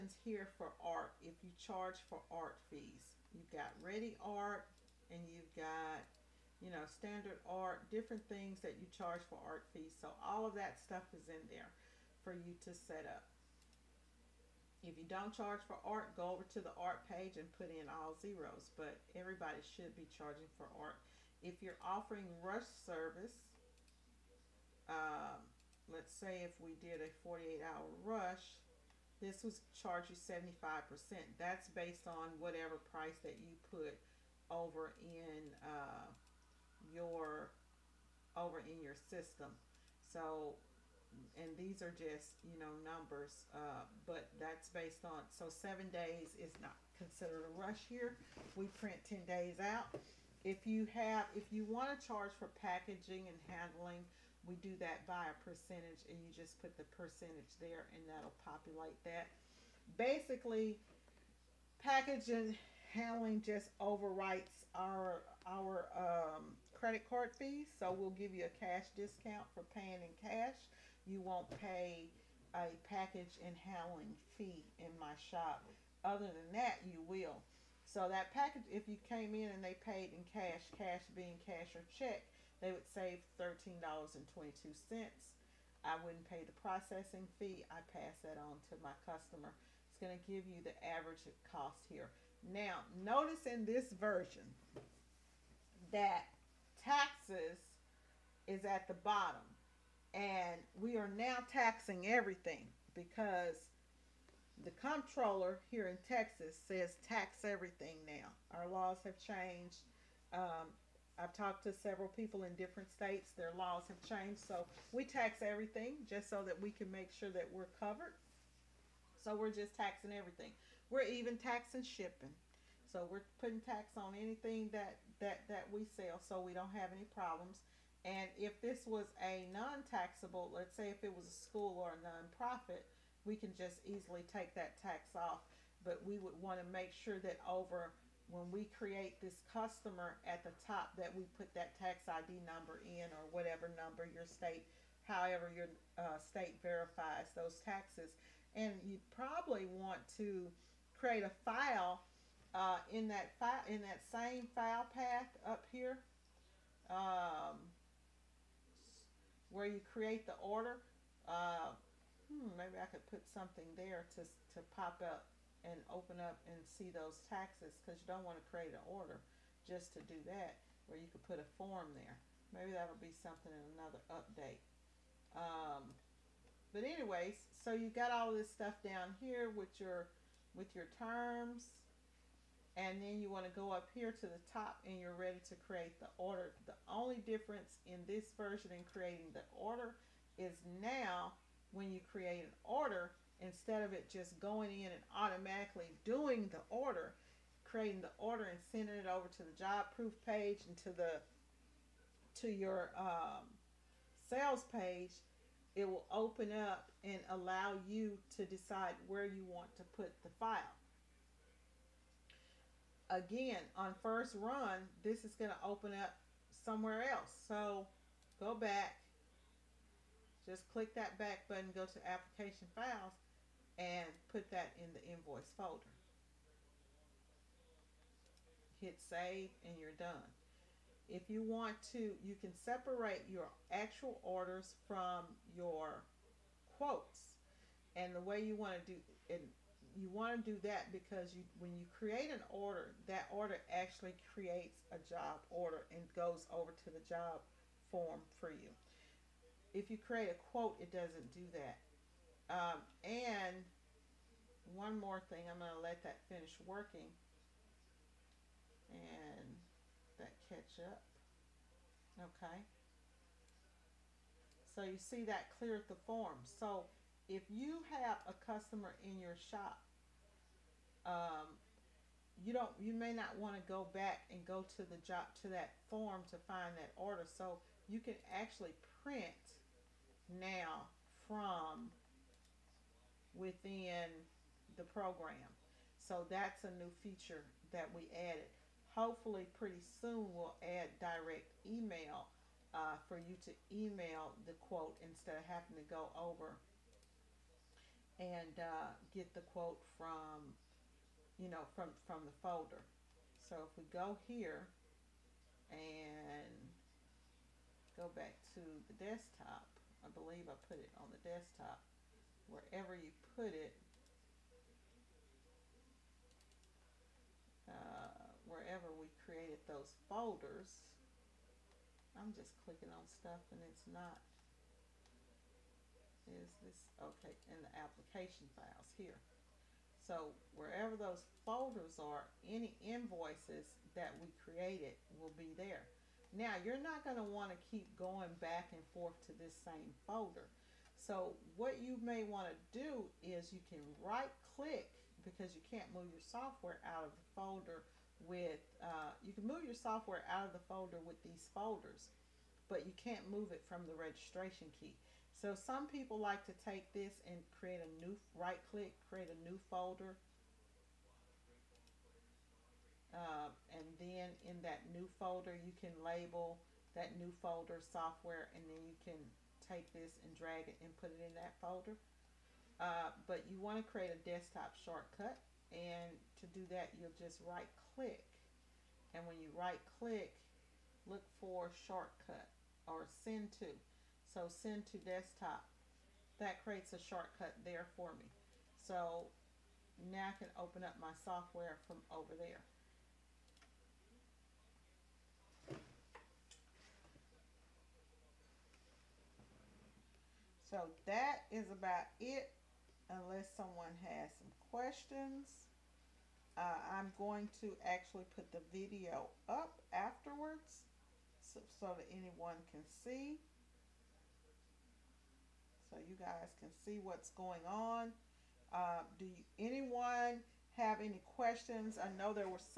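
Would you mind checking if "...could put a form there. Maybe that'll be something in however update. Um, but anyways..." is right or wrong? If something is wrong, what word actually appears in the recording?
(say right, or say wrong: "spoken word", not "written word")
wrong: "another", not "however".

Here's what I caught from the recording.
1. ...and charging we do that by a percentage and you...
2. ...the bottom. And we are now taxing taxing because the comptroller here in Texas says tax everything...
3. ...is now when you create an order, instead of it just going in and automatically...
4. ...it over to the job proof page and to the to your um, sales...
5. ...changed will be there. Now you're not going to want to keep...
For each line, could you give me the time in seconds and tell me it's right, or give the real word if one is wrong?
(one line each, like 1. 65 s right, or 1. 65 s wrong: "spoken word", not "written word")
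1. 53 s wrong: "handling", not "charging"
2. 98 s wrong: "everything", not "taxing"
3. 190 s right
4. 198 s right
5. 334 s wrong: "created", not "changed".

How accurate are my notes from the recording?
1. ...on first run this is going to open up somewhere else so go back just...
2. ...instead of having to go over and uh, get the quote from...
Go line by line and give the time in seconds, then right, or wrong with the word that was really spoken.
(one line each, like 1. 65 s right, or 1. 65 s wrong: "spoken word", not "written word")
1. 213 s right
2. 295 s right.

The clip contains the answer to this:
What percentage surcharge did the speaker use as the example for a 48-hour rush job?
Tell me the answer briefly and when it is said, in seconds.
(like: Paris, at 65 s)
75%, at 30 s.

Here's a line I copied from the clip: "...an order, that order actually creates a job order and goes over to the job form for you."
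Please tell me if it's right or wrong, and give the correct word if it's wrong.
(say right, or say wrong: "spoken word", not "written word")
right.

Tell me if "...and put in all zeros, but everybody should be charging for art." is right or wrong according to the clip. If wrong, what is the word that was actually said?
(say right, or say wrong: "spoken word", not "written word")
right.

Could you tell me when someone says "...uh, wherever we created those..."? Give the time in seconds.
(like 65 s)
317 s.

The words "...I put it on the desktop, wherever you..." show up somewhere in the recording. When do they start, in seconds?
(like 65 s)
310 s.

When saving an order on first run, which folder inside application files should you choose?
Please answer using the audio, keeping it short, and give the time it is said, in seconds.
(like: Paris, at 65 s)
invoice folder, at 225 s.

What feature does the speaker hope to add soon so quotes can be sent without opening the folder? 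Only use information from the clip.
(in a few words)
direct email.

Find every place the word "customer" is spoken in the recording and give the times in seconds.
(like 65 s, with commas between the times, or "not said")
89 s, 139 s, 268 s.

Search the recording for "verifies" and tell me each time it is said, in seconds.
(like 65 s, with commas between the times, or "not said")
146 s.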